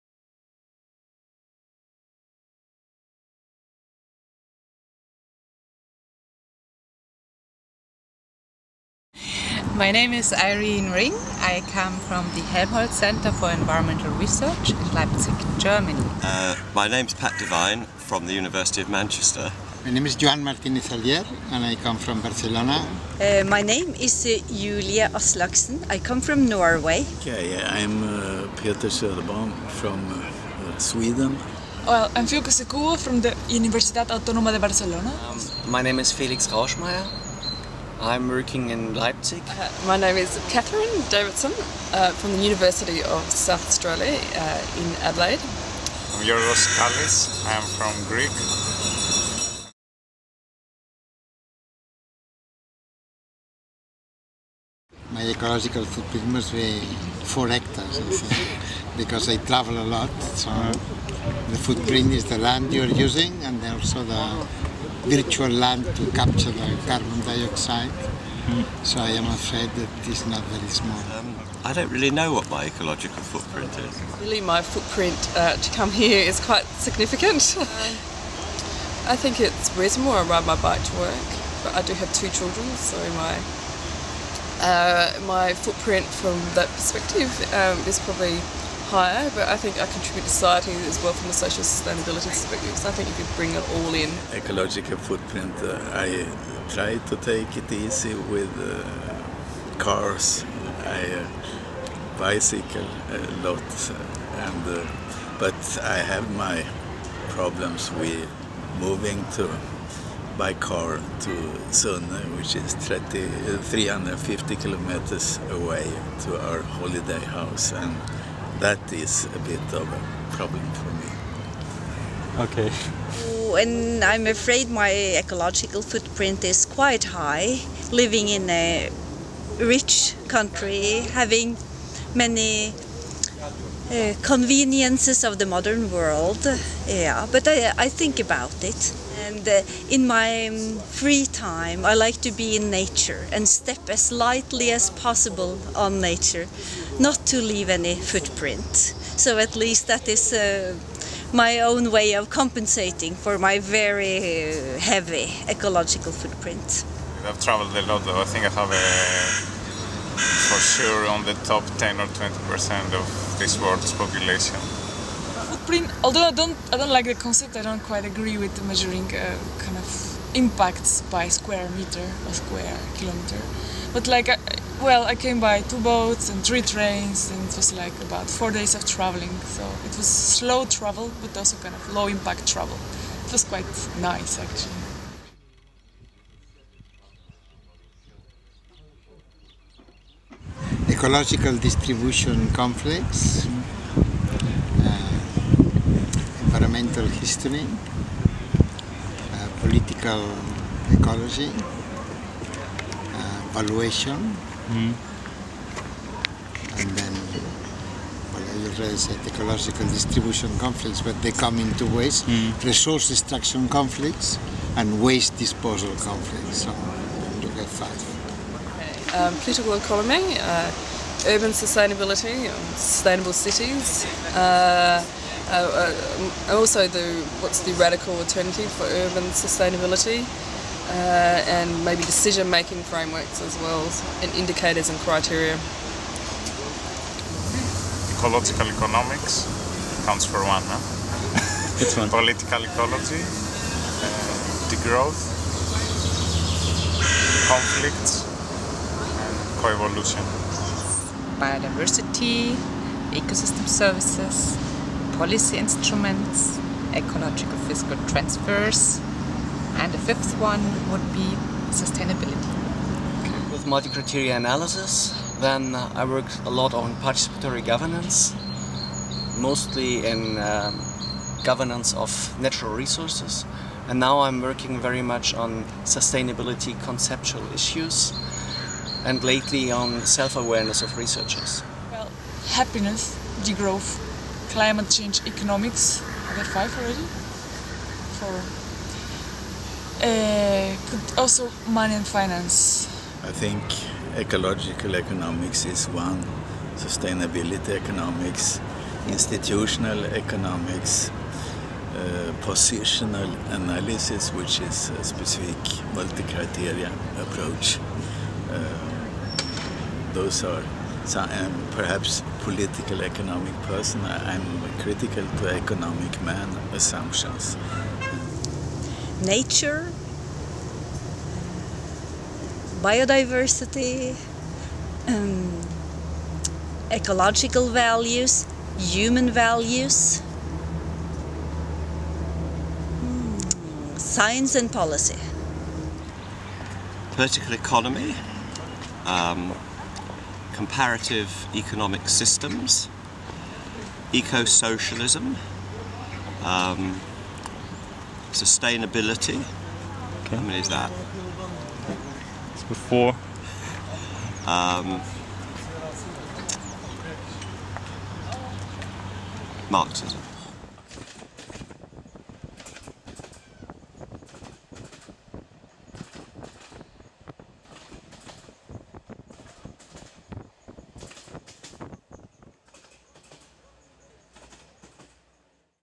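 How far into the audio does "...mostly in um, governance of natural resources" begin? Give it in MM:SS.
04:29.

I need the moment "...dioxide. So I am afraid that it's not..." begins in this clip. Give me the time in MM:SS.
01:07.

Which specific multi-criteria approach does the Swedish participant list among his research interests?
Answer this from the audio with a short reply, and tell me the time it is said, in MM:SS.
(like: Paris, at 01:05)
positional analysis, at 05:02.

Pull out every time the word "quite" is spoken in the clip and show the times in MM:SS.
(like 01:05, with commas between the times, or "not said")
01:16, 02:06, 02:47, 03:03.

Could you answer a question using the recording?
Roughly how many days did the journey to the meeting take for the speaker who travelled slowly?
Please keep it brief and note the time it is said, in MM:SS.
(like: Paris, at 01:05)
4, at 02:58.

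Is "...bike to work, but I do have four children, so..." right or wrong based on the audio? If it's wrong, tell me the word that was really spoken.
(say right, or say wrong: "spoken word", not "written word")
wrong: "two", not "four".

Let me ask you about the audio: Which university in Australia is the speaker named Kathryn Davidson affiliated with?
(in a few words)
University of South Australia.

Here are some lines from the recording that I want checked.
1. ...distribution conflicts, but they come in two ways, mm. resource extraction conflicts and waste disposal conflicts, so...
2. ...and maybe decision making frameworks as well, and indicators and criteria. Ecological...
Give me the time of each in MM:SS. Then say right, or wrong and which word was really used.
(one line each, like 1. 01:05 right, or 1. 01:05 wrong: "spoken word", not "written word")
1. 03:29 right
2. 03:51 right.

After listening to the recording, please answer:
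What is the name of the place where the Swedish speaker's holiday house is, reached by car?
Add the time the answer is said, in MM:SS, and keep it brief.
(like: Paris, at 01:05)
Sunne, at 01:51.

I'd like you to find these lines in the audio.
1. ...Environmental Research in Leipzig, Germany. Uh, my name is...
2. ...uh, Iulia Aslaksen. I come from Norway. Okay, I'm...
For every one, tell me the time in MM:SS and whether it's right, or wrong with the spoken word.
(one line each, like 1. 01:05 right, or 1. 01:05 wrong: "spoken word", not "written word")
1. 00:13 right
2. 00:24 right.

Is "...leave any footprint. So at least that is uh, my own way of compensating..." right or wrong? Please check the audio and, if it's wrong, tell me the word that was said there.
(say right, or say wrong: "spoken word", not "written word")
right.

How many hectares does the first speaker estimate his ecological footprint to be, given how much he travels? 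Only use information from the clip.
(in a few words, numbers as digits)
4.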